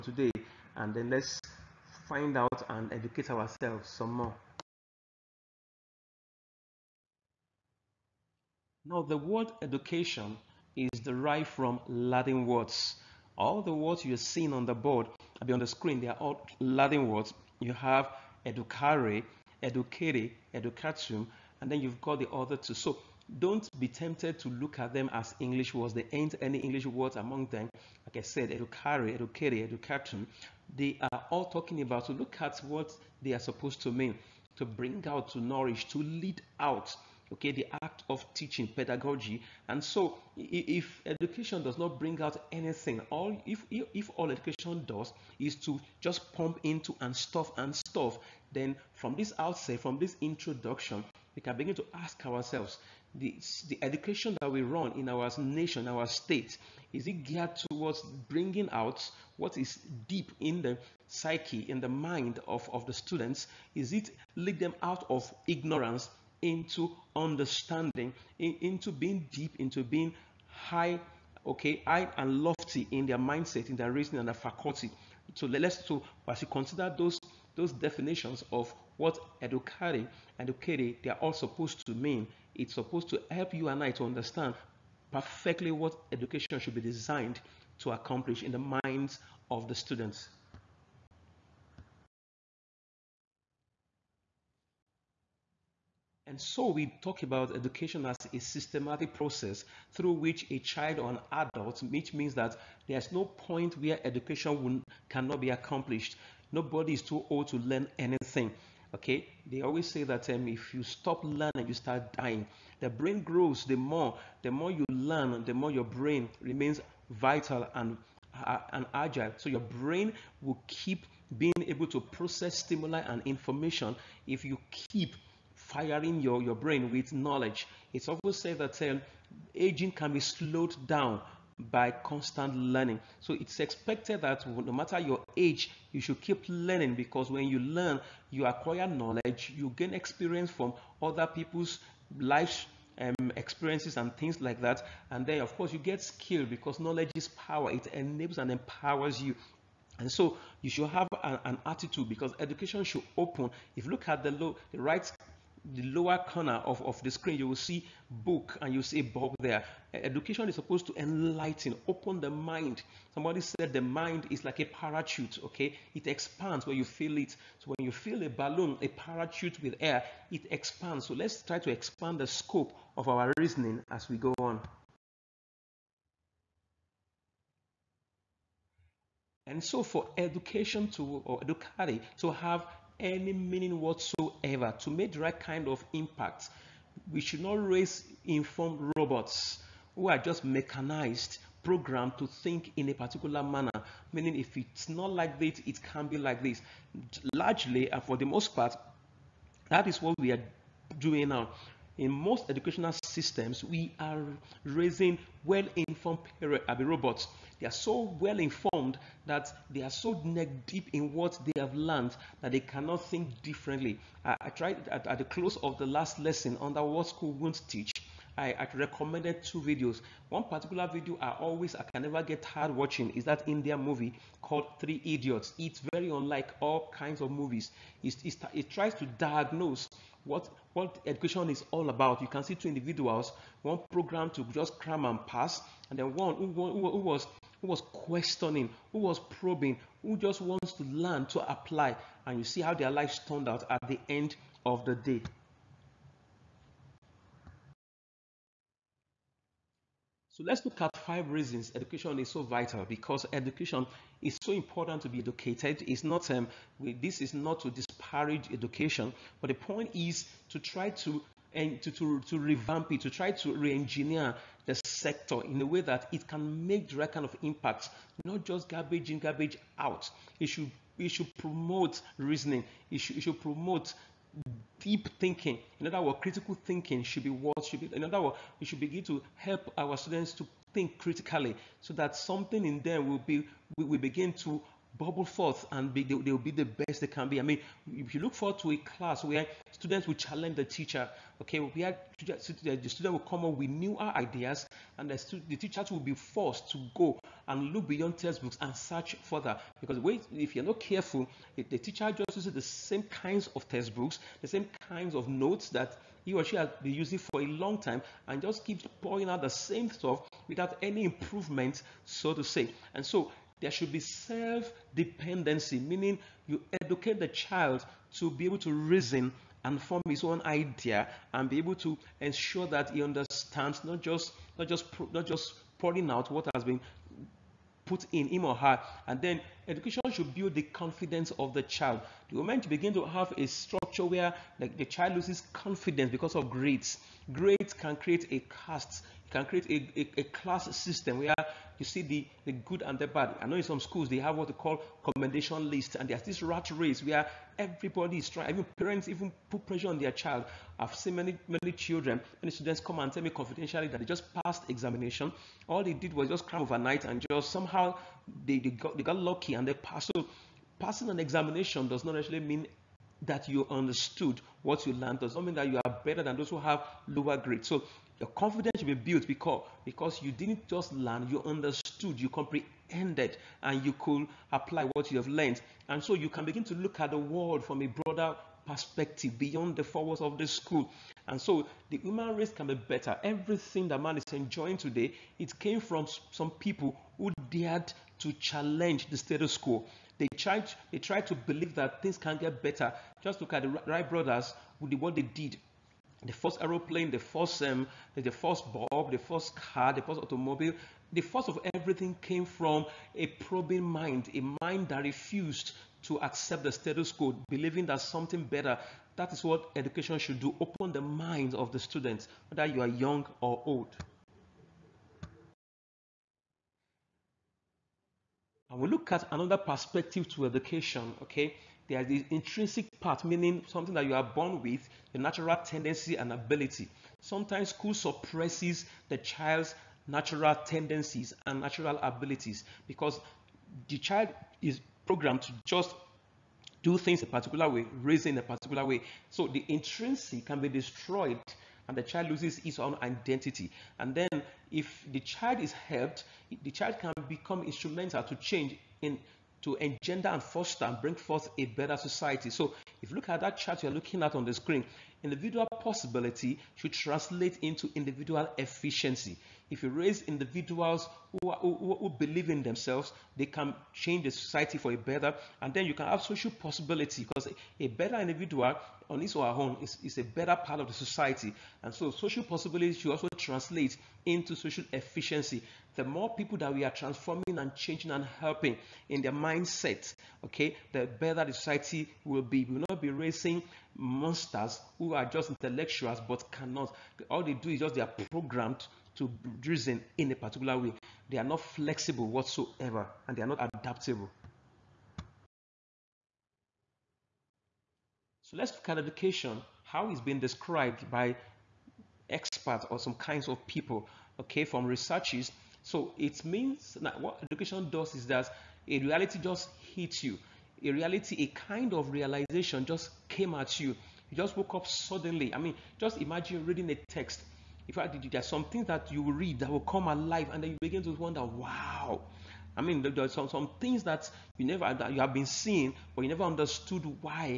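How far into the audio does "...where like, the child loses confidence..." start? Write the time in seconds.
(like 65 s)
334 s.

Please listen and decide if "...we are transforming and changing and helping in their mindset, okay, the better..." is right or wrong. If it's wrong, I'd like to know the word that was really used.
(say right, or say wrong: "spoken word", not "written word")
right.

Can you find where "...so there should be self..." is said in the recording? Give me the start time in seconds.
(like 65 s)
313 s.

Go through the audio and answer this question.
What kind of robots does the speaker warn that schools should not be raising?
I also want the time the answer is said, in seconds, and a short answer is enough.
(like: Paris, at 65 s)
Informed robots, at 188 s.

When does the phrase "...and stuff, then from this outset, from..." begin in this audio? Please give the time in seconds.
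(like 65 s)
47 s.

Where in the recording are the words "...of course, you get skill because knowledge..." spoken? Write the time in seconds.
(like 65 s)
145 s.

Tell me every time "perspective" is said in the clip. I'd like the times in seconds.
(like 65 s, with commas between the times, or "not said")
378 s, 419 s.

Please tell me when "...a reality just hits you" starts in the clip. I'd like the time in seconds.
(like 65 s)
508 s.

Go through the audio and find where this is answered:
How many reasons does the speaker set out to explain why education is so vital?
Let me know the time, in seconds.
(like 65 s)
250 s.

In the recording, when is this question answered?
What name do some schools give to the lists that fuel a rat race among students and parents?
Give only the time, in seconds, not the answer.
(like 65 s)
345 s.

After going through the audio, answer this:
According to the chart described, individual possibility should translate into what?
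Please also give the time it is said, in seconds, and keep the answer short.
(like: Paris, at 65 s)
Individual efficiency, at 457 s.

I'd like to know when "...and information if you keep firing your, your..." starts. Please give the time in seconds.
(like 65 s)
123 s.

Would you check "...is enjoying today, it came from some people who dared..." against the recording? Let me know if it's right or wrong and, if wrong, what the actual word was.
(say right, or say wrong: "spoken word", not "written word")
right.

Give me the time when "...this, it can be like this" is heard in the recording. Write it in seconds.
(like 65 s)
195 s.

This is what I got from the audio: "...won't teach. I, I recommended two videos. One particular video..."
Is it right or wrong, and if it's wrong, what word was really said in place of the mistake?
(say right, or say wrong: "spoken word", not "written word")
right.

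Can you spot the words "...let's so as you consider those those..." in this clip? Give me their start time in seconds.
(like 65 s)
75 s.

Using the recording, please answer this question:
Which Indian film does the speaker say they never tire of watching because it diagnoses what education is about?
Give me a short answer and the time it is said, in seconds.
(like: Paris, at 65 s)
Three Idiots, at 224 s.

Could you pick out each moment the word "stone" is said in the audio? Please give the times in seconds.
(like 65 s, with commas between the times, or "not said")
not said.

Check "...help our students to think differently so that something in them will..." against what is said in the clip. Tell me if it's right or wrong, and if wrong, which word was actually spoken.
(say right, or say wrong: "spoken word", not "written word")
wrong: "critically", not "differently".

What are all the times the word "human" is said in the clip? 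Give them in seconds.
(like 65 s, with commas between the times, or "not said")
381 s.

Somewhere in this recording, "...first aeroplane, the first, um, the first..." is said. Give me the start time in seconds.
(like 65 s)
396 s.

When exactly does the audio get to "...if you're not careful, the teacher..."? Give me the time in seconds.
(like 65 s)
300 s.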